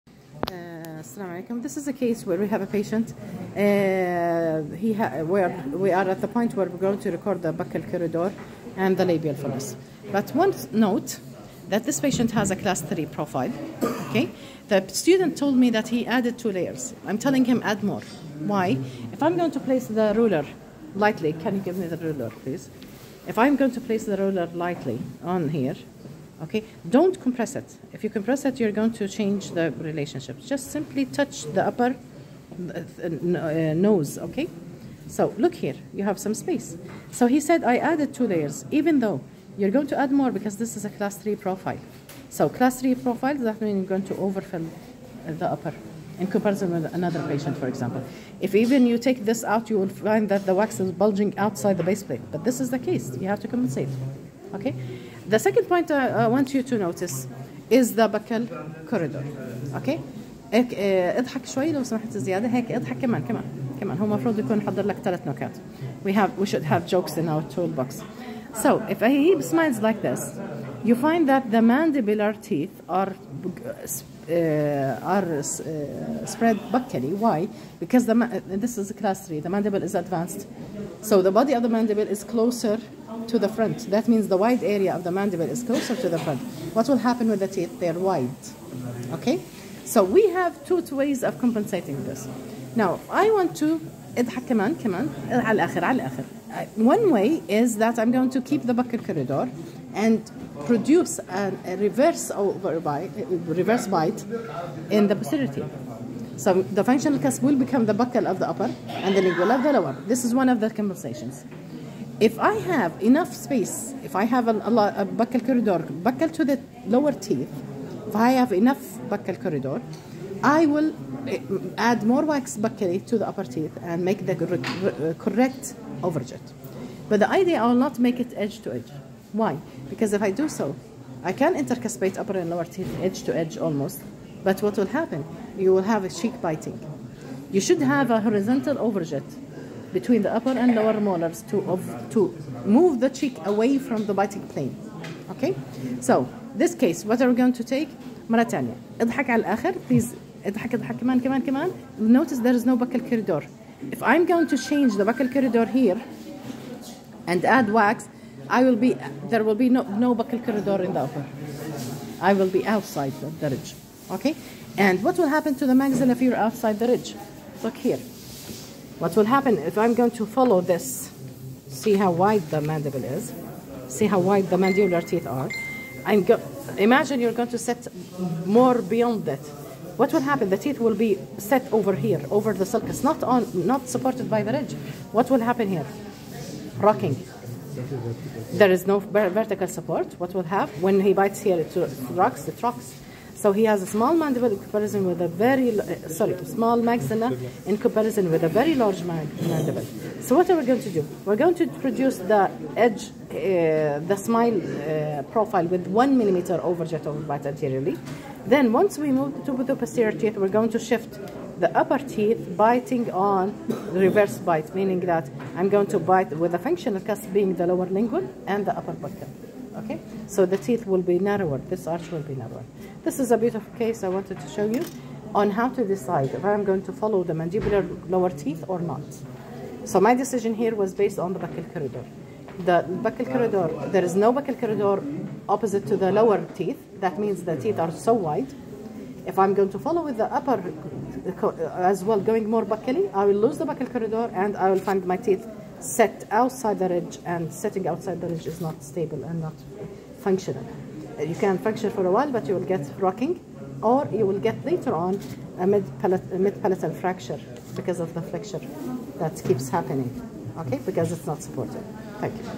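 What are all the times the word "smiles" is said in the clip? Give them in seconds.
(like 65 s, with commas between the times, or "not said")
69 s, 204 s.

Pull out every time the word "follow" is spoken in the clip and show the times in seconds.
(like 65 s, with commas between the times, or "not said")
170 s, 226 s, 239 s.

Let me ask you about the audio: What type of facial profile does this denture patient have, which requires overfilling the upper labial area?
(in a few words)
Class 3.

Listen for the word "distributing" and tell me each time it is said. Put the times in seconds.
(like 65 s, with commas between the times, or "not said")
not said.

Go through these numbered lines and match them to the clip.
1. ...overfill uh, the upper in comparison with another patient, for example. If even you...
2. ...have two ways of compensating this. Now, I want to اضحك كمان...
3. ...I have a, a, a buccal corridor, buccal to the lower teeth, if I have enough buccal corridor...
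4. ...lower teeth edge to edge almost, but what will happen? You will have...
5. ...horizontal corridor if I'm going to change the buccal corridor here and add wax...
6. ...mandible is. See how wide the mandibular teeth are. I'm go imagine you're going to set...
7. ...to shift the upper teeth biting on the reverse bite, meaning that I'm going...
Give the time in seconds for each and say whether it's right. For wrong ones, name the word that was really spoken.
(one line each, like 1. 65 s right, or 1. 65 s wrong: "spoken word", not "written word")
1. 44 s right
2. 90 s right
3. 114 s right
4. 132 s right
5. 152 s wrong: "buccal", not "horizontal"
6. 172 s right
7. 210 s right.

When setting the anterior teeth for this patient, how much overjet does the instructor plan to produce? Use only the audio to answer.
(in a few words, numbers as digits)
1 millimeter.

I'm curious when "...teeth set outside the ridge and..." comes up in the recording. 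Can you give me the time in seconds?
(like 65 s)
245 s.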